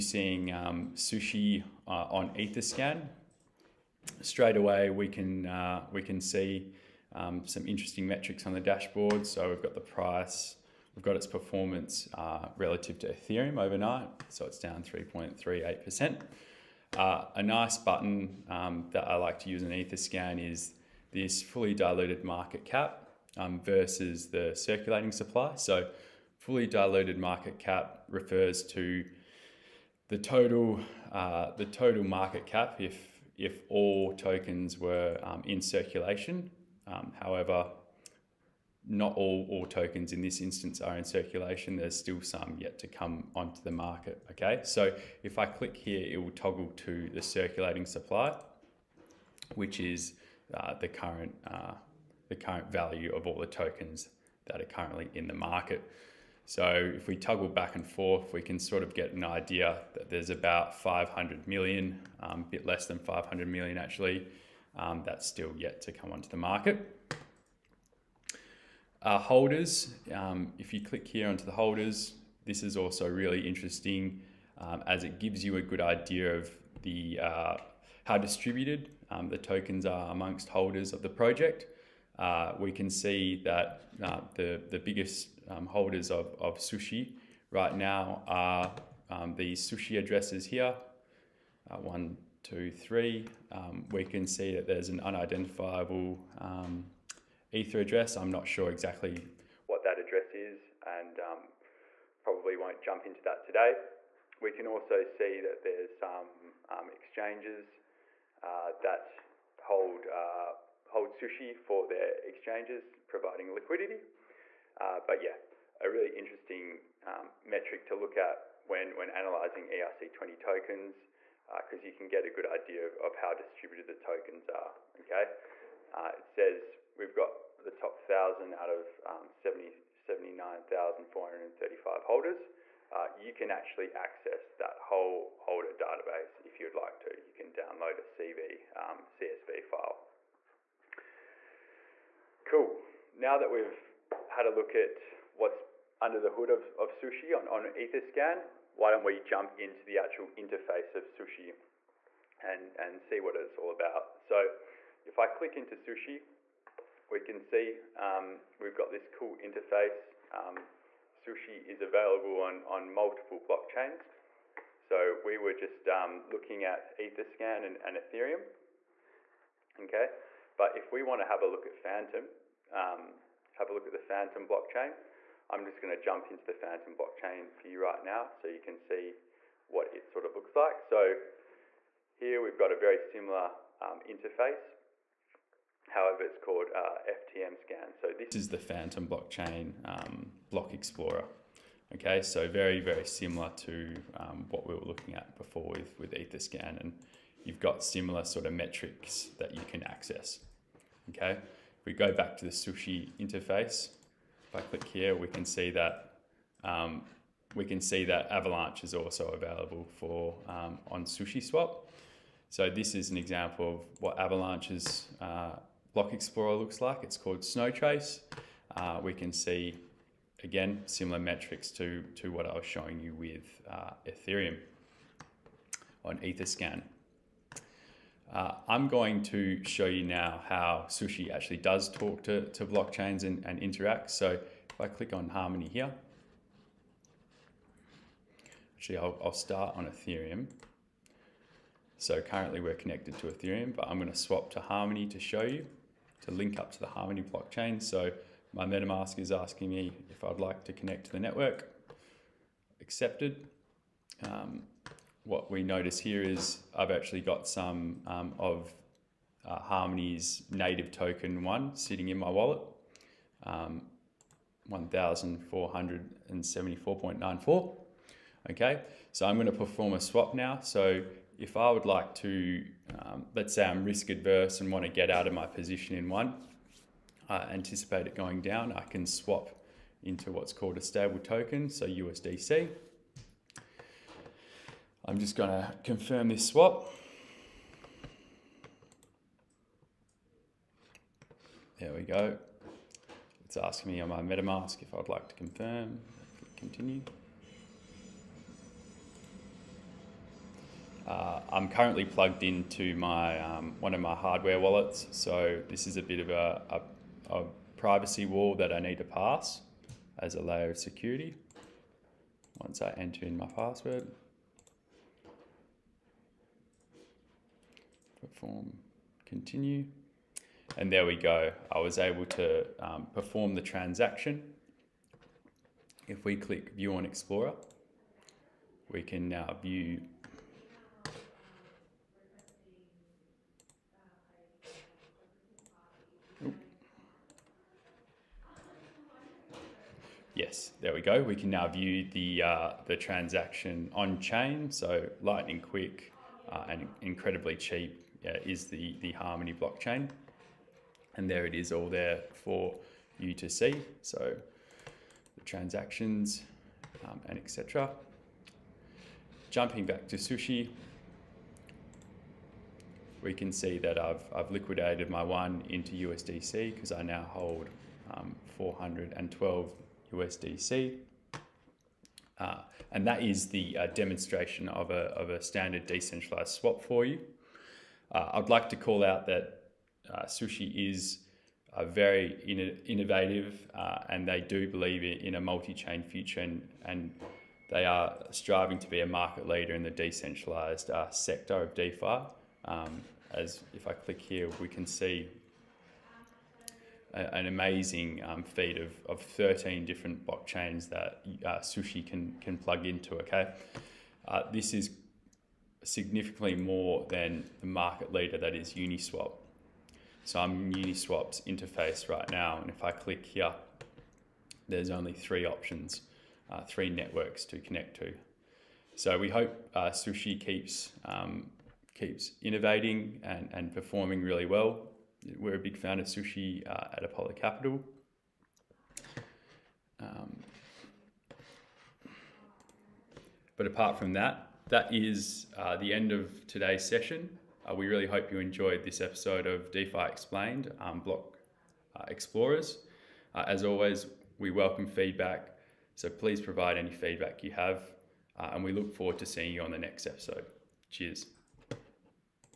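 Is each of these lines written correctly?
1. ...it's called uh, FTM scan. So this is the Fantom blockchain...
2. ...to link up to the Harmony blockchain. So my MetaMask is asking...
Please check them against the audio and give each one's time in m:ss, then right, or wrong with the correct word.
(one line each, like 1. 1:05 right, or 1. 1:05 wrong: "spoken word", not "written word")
1. 3:06 right
2. 4:06 right.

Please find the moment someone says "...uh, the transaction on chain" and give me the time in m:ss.
5:42.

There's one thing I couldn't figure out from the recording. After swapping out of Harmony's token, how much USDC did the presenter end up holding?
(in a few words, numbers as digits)
412 USDC.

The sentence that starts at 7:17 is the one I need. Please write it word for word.
Uh, we really hope you enjoyed this episode of DeFi Explained um, Block uh, Explorers.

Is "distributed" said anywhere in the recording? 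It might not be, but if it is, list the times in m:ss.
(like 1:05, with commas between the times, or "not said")
1:18, 2:03.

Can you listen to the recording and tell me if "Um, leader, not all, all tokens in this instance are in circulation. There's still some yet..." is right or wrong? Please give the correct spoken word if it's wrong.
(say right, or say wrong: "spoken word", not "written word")
wrong: "however", not "leader".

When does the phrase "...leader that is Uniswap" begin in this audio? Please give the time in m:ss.
6:48.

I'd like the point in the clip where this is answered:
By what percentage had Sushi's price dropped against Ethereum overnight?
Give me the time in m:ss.
0:14.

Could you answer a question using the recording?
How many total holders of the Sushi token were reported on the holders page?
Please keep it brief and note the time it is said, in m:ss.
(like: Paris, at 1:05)
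79,435, at 2:09.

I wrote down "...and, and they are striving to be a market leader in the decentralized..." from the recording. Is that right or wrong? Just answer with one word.
right.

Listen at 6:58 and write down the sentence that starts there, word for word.
So we hope uh, Sushi keeps um, keeps innovating and, and performing really well.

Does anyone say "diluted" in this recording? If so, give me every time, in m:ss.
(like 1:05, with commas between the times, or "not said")
0:21, 0:26.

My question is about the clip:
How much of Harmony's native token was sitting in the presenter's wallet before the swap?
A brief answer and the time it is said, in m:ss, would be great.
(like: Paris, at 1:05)
1,474.94, at 4:24.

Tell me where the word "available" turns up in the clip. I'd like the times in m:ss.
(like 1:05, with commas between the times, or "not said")
2:41, 3:29.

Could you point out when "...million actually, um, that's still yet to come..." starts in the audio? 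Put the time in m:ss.
1:03.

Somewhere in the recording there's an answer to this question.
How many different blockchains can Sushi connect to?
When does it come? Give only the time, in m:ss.
6:39.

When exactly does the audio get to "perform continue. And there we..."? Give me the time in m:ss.
5:18.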